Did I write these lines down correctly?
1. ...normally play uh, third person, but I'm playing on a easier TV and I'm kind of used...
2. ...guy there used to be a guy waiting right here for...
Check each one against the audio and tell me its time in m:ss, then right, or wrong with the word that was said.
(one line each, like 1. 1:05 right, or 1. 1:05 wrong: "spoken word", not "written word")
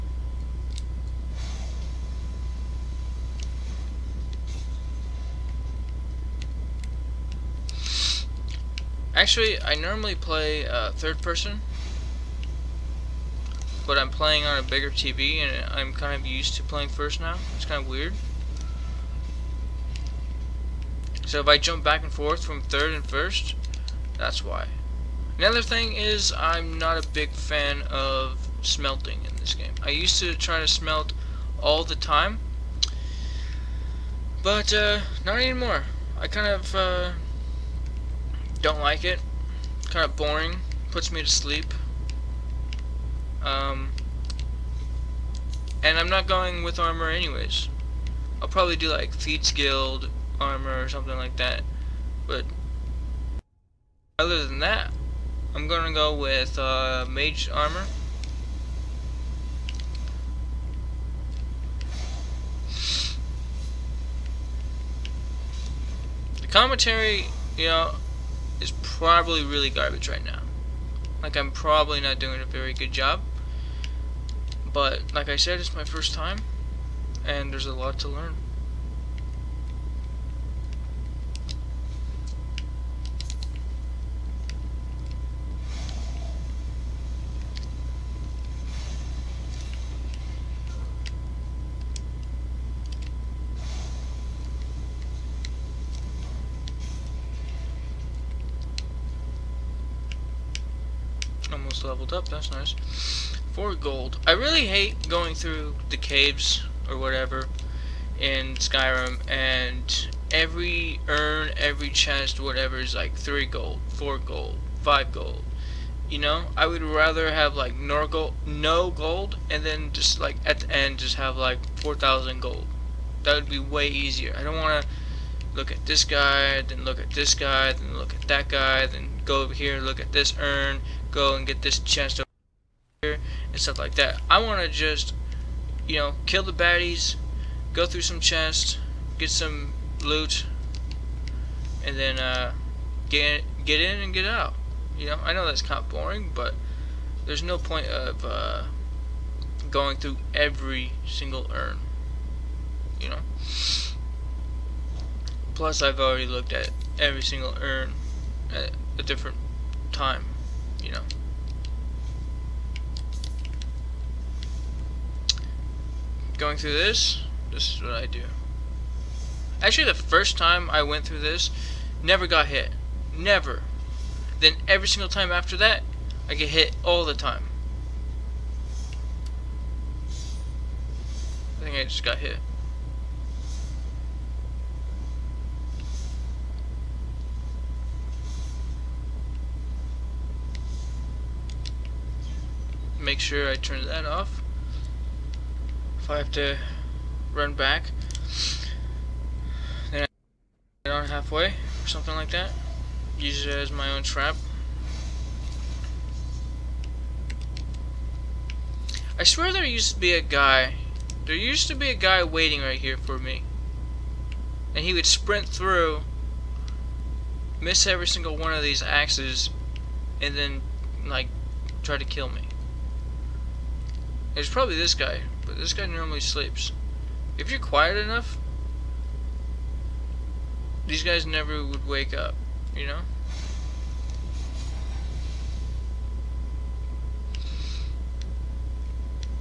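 1. 0:09 wrong: "bigger", not "easier"
2. 3:30 right.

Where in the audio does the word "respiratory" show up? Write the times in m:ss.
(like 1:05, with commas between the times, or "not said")
not said.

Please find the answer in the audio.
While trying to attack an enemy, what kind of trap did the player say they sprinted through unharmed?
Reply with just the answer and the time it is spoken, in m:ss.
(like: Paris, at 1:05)
axes, at 3:38.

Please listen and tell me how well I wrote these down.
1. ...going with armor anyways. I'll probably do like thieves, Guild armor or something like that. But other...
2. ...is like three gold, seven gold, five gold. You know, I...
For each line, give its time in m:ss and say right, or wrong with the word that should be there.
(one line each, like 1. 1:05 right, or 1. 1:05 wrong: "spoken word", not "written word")
1. 0:46 right
2. 1:52 wrong: "four", not "seven".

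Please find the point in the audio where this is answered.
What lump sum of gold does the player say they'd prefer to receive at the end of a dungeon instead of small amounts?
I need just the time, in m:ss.
2:01.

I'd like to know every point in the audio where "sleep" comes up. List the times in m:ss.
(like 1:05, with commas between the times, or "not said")
0:41, 3:46.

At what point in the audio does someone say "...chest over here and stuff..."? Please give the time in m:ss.
2:11.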